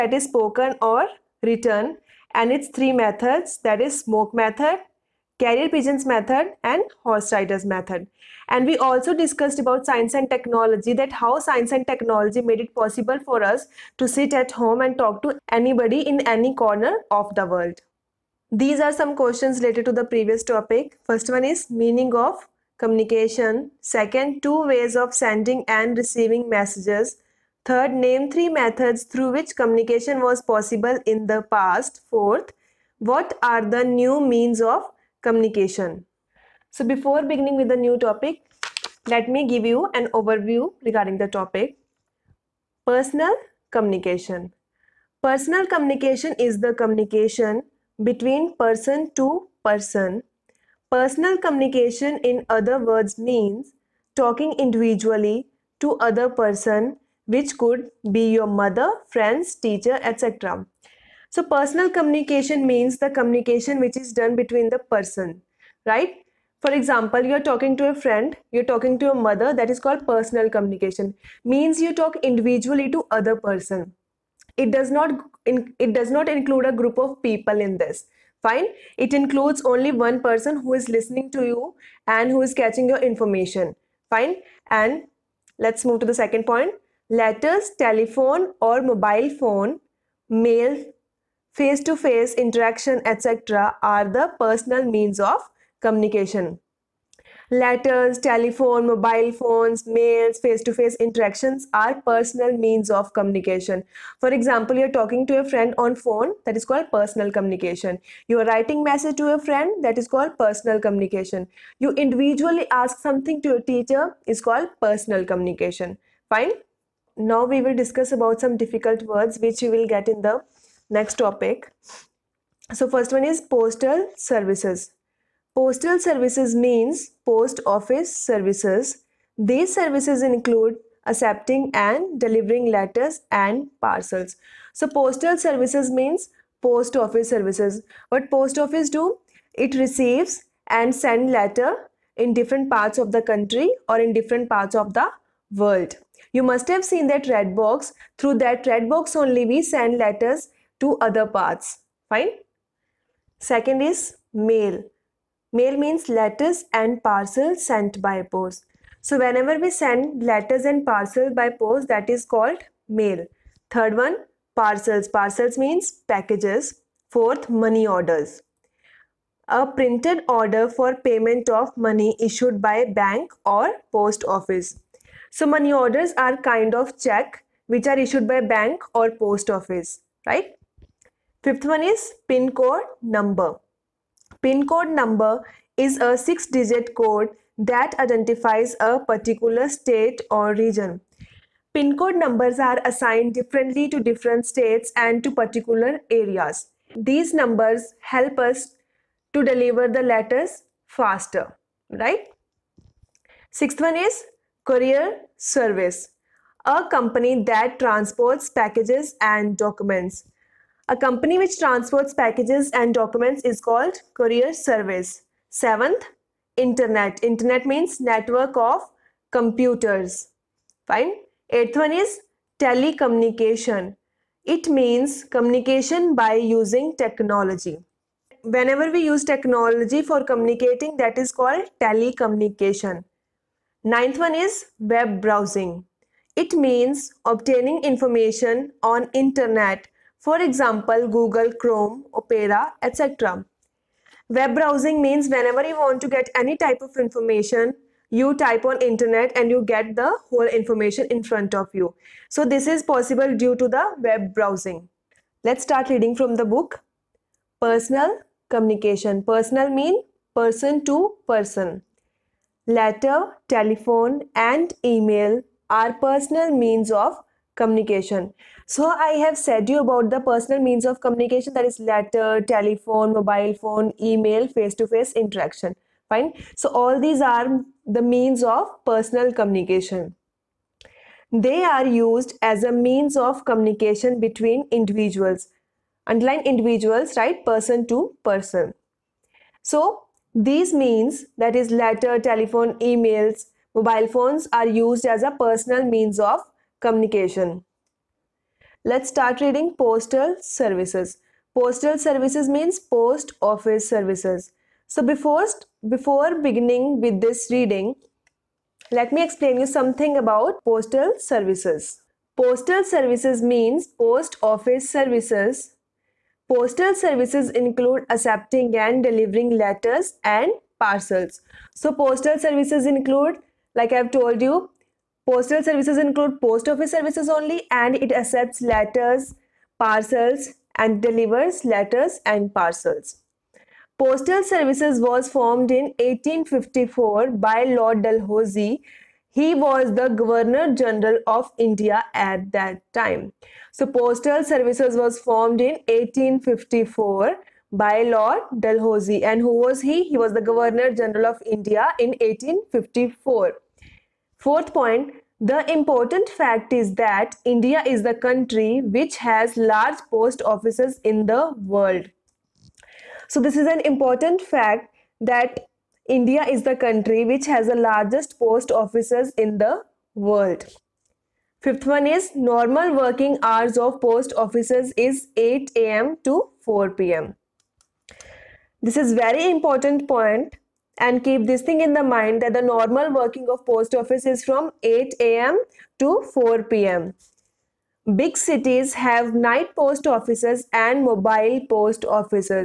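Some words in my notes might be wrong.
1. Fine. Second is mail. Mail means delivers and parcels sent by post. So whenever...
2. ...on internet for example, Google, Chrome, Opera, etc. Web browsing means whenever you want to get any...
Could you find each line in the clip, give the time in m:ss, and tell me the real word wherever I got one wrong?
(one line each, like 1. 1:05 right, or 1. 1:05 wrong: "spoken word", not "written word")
1. 2:32 wrong: "letters", not "delivers"
2. 3:58 right.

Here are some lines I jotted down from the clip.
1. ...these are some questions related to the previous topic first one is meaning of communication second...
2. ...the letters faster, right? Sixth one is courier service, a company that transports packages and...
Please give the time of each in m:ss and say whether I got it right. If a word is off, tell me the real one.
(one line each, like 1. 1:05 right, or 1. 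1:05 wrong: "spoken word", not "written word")
1. 0:18 right
2. 3:19 right.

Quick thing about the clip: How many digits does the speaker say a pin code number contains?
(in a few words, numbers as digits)
6.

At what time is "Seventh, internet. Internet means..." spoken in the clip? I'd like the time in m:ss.
3:35.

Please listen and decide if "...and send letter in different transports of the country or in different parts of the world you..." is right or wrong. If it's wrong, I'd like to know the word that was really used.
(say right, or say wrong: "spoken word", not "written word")
wrong: "parts", not "transports".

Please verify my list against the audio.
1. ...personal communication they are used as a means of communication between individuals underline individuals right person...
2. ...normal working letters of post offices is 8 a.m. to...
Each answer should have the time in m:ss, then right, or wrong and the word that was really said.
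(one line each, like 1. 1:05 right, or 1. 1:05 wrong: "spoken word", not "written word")
1. 4:38 right
2. 6:12 wrong: "hours", not "letters".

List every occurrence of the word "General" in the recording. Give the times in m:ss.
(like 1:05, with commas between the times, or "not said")
5:40, 5:50.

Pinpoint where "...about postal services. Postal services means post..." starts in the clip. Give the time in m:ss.
5:10.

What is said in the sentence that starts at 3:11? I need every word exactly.
Pin code numbers are assigned differently to different states and to particular areas.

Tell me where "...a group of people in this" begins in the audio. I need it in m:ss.
1:16.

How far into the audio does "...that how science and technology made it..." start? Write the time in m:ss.
0:10.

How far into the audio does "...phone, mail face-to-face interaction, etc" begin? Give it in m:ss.
1:29.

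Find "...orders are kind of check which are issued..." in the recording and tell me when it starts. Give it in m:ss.
2:55.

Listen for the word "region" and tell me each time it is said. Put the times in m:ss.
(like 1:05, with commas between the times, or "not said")
3:10.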